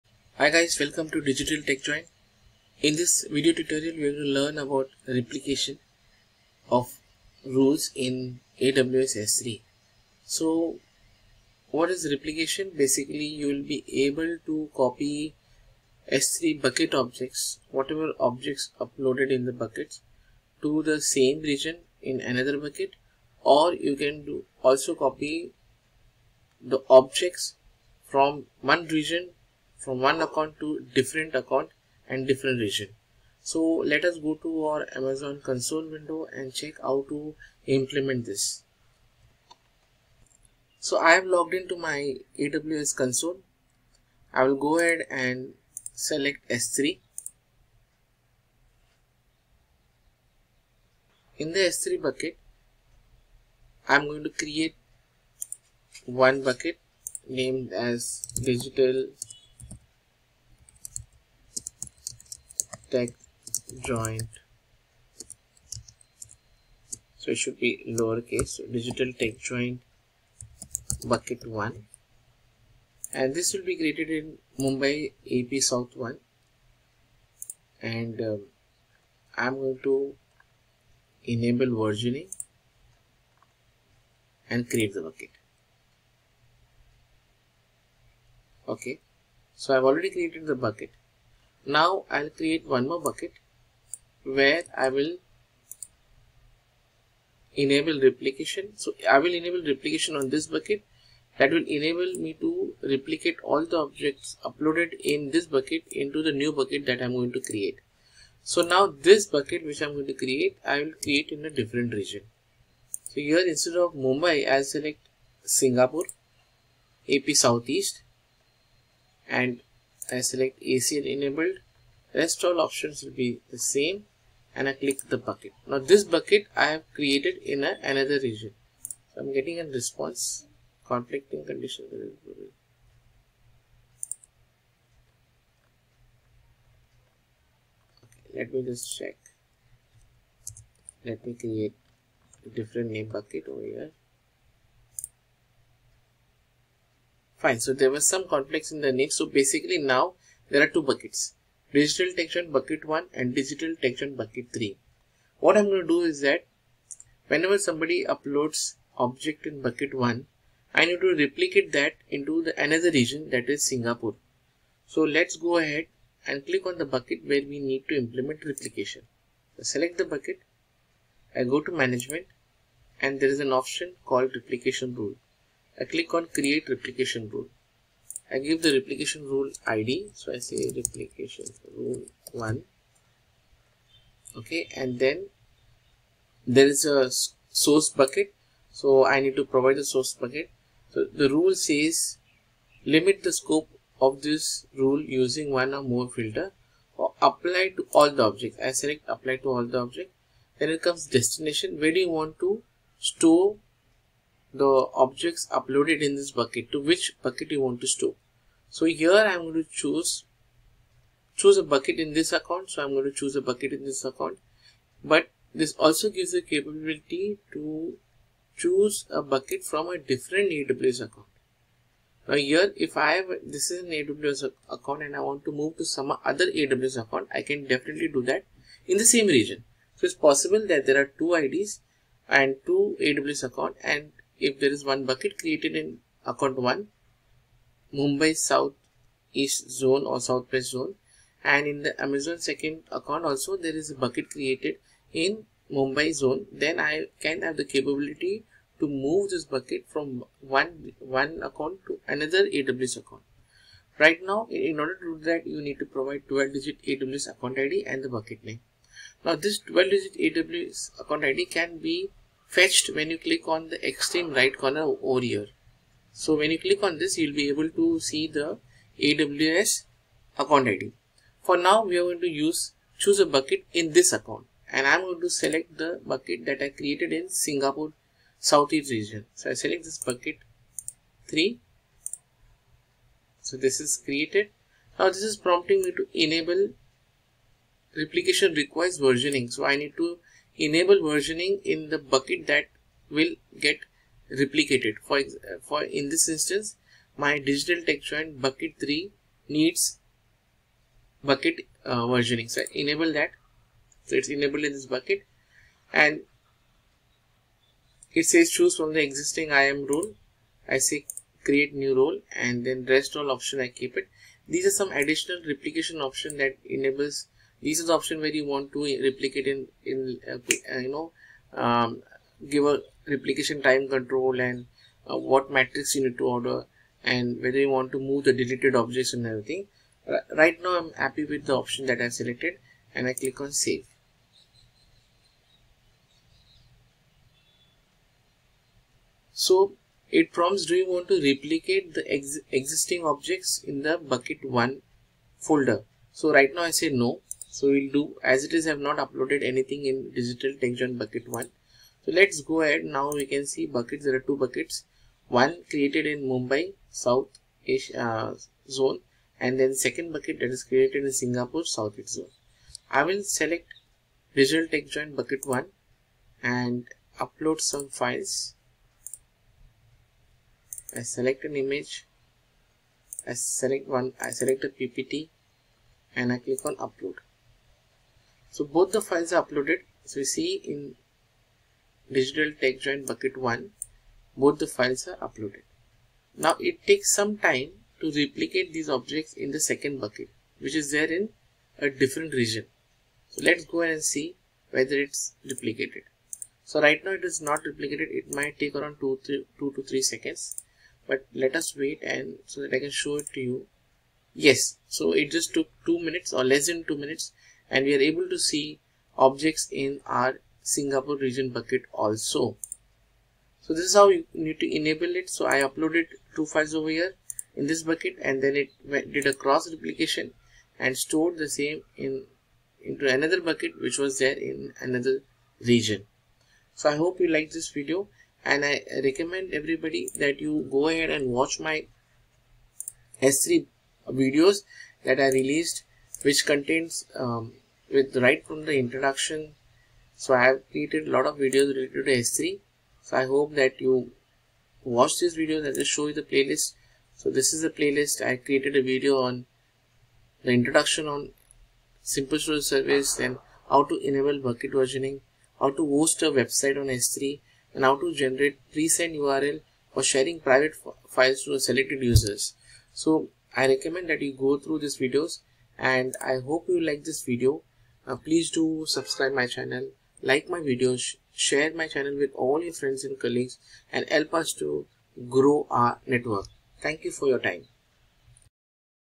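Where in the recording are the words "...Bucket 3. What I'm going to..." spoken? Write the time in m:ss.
2:34.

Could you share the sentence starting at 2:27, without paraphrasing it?
So there was some conflicts in the name.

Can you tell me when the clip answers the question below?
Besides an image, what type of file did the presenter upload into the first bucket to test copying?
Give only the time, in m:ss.
6:14.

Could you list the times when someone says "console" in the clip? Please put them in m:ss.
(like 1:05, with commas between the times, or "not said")
0:35, 0:42.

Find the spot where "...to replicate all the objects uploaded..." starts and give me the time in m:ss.
1:42.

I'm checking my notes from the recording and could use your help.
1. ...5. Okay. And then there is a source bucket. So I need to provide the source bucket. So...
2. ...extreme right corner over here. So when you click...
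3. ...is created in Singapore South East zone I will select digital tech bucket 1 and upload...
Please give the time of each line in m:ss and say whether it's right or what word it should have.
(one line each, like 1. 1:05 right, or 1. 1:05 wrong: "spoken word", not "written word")
1. 3:02 wrong: "1", not "5"
2. 4:23 right
3. 6:00 right.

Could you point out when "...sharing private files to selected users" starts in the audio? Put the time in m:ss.
7:40.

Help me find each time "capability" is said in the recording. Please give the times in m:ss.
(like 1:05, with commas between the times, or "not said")
3:36, 4:07.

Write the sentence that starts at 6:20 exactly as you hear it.
So you see in digital tech joint bucket 1, both the files are uploaded.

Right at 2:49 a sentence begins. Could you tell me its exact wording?
So select the bucket, I go to management and there is an option called replication rule.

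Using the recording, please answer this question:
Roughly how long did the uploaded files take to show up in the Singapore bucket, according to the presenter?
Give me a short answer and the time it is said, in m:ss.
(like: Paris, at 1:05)
less than 2 minutes, at 6:46.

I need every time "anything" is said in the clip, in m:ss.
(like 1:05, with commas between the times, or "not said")
5:49.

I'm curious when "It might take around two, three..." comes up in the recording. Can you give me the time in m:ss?
6:38.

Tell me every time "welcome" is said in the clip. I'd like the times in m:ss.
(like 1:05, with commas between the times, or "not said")
0:00.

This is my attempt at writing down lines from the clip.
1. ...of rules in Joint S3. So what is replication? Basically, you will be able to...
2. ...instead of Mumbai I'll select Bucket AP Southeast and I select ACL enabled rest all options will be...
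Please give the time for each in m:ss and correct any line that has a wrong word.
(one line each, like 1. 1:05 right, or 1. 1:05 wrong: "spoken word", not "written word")
1. 0:06 wrong: "AWS", not "Joint"
2. 1:53 wrong: "Singapore", not "Bucket".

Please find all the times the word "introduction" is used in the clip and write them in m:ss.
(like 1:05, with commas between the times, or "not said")
7:18, 7:30.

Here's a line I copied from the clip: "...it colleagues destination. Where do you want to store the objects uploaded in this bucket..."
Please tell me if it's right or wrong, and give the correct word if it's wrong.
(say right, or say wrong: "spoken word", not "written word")
wrong: "comes", not "colleagues".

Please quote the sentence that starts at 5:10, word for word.
I say create new role and then rest all option I keep it.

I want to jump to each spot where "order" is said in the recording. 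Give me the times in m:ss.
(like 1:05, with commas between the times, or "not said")
4:14, 5:26.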